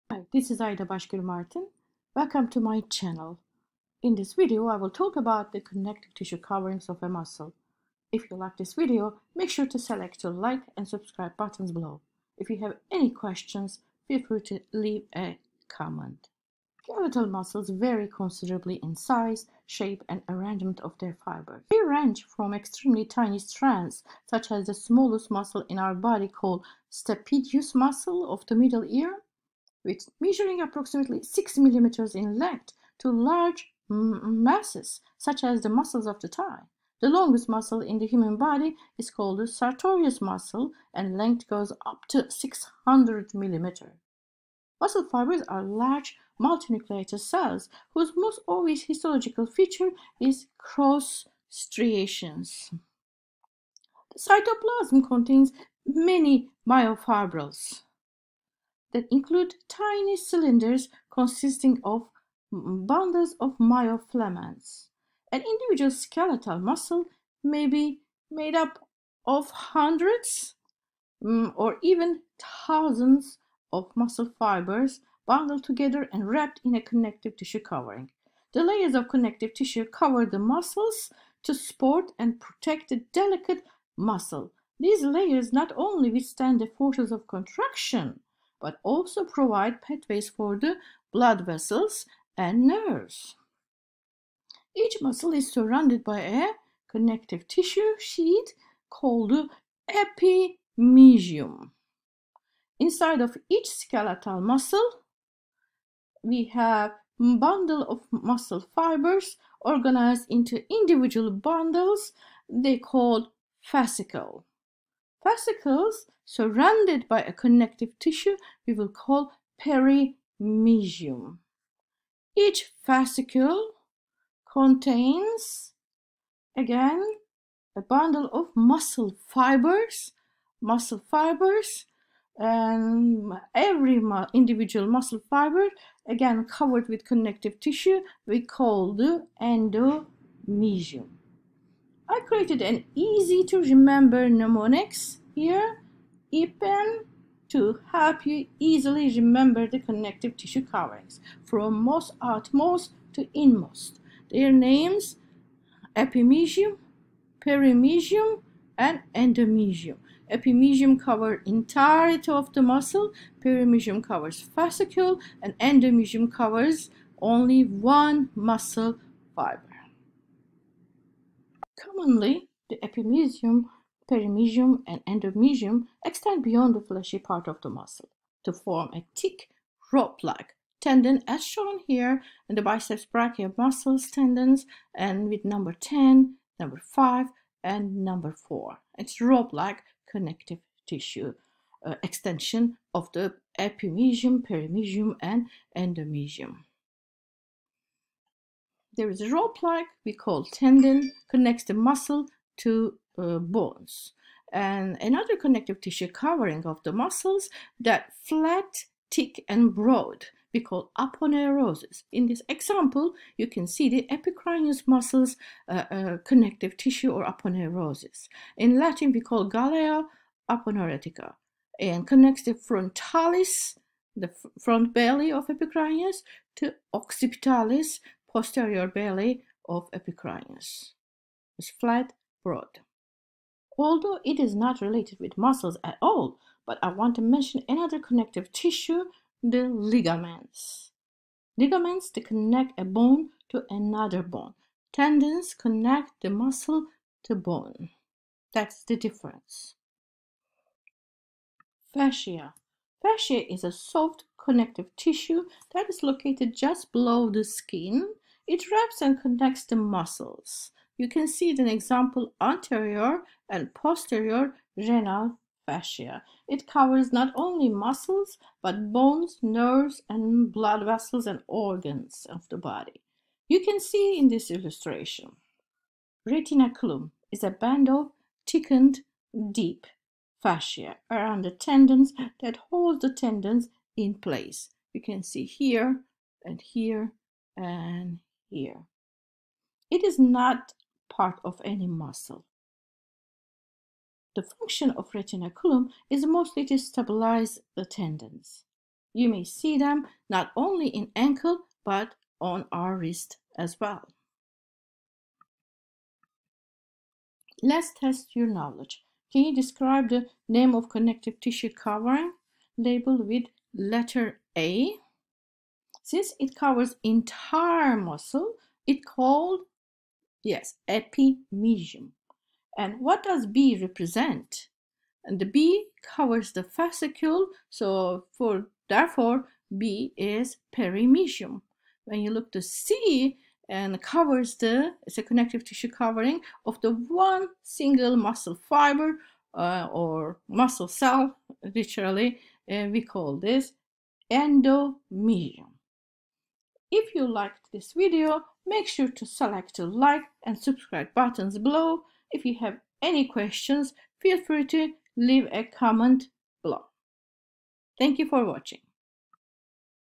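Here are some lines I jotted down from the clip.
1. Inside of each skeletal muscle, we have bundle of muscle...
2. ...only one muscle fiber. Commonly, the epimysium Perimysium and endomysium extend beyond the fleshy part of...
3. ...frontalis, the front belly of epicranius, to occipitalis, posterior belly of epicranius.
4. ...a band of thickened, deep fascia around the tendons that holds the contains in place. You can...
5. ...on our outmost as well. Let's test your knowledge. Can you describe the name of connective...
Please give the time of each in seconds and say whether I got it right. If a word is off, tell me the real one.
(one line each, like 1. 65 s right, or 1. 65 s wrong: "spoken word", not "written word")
1. 102 s right
2. 167 s right
3. 222 s right
4. 277 s wrong: "tendons", not "contains"
5. 302 s wrong: "wrist", not "outmost".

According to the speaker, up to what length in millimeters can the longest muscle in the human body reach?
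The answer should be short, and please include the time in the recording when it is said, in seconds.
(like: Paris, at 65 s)
600 millimeters, at 42 s.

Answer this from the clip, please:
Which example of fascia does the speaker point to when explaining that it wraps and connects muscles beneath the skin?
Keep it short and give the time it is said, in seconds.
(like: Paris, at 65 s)
renal fascia, at 264 s.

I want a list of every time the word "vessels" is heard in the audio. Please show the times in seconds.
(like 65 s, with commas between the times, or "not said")
91 s, 270 s.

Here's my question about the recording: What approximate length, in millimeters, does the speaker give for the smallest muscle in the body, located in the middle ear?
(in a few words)
6 millimeters.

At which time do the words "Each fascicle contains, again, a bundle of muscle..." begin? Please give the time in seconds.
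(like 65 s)
122 s.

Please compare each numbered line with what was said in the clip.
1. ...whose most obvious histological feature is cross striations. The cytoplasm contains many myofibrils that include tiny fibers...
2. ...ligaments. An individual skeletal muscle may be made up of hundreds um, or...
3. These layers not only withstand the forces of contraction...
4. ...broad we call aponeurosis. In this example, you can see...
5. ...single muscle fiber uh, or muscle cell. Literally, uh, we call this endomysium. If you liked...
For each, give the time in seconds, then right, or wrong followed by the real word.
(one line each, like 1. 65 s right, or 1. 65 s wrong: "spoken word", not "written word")
1. 47 s wrong: "cylinders", not "fibers"
2. 63 s wrong: "myofilaments", not "ligaments"
3. 84 s right
4. 209 s right
5. 337 s right.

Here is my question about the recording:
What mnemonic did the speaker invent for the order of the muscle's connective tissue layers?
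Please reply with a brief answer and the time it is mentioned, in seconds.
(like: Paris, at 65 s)
EPAM, at 146 s.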